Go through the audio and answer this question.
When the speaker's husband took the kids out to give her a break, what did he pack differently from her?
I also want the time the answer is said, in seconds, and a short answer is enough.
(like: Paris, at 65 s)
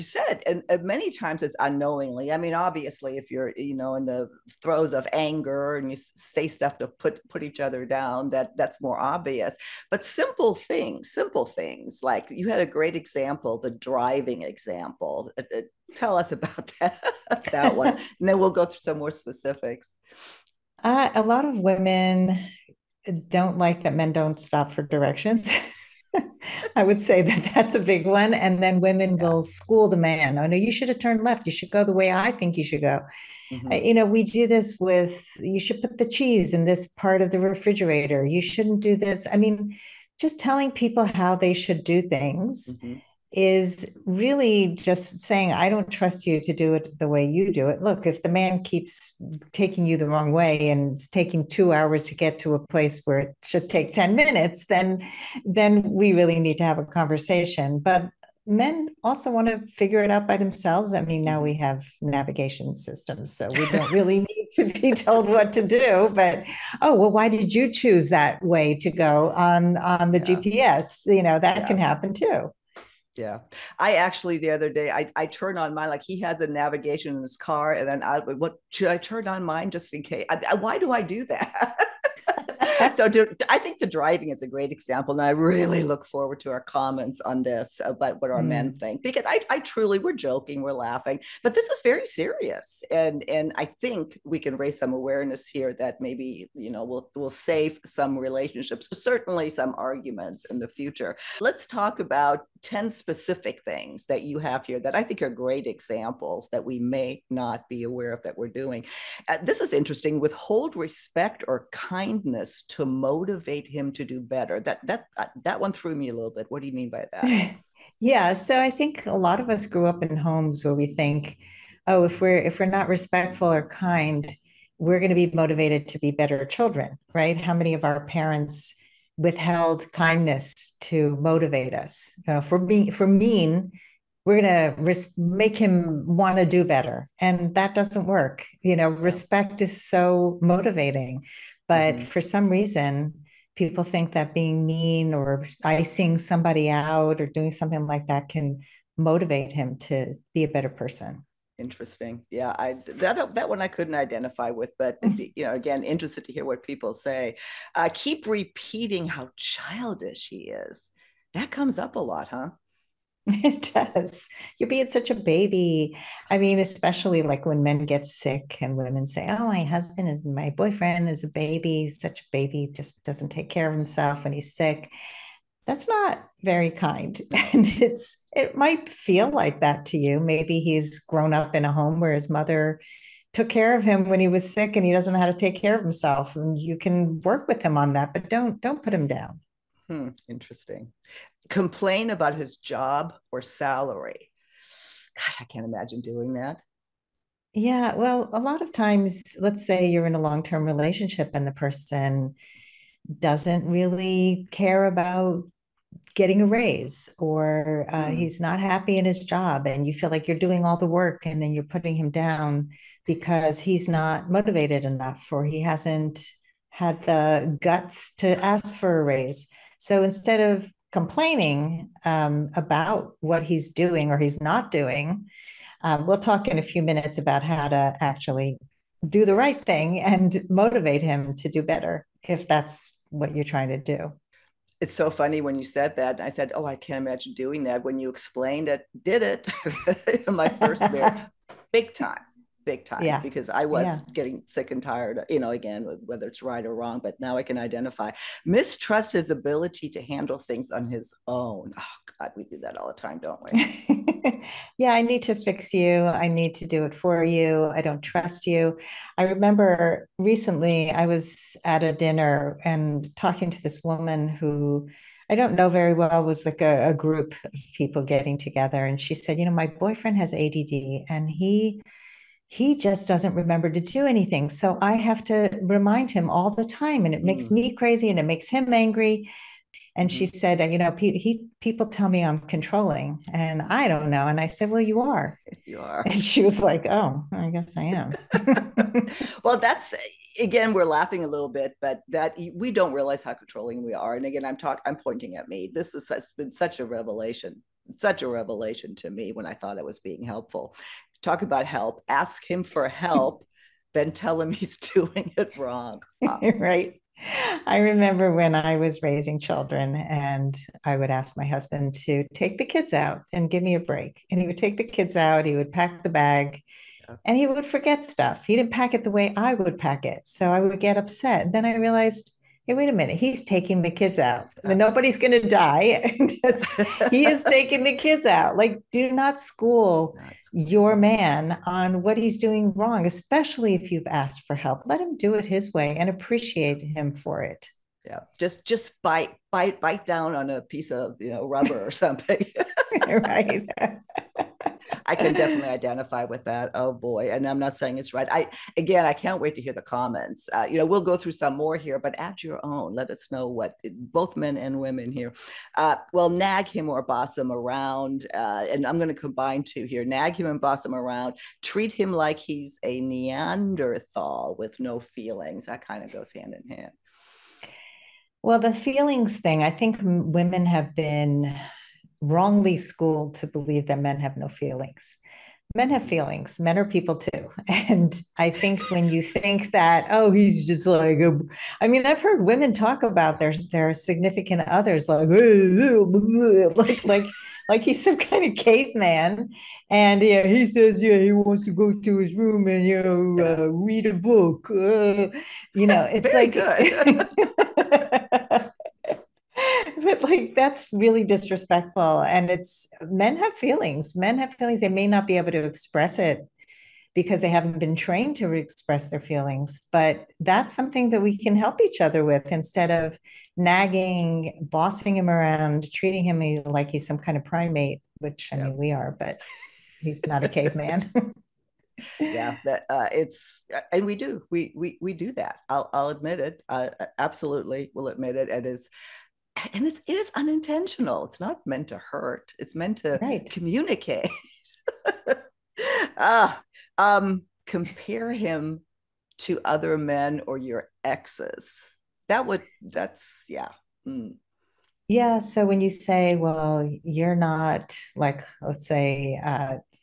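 the bag, at 316 s.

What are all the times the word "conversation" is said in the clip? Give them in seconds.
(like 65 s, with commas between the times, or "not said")
56 s.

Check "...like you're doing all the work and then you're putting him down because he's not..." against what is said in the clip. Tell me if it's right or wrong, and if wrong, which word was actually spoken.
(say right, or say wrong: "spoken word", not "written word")
right.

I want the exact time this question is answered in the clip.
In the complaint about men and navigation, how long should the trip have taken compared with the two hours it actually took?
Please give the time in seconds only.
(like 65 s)
53 s.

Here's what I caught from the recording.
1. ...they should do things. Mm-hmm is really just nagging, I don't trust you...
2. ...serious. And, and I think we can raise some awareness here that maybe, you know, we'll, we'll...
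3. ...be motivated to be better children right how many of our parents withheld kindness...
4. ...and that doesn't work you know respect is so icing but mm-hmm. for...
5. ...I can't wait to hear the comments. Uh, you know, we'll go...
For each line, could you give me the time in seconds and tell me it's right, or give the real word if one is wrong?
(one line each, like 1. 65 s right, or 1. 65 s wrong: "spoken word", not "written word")
1. 41 s wrong: "saying", not "nagging"
2. 92 s right
3. 125 s right
4. 137 s wrong: "motivating", not "icing"
5. 349 s right.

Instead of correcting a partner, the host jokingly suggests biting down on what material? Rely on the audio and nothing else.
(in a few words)
rubber.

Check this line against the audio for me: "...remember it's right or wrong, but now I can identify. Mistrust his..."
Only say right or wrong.
wrong.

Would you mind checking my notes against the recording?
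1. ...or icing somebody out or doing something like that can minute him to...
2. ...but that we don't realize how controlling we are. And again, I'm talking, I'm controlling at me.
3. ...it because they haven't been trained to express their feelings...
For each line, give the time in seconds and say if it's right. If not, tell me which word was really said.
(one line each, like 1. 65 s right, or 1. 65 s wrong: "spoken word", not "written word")
1. 145 s wrong: "motivate", not "minute"
2. 291 s wrong: "pointing", not "controlling"
3. 406 s right.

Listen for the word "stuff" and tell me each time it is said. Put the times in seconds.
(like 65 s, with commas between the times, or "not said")
6 s, 318 s.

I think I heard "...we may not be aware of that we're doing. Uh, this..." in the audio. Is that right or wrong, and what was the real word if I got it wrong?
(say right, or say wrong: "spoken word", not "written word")
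right.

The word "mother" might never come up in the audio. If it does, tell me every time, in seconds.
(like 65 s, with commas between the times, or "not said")
182 s.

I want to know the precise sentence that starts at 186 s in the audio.
And you can work with him on that, but don't don't put him down.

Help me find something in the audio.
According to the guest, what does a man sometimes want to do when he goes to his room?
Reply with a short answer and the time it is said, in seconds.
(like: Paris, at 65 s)
read a book, at 393 s.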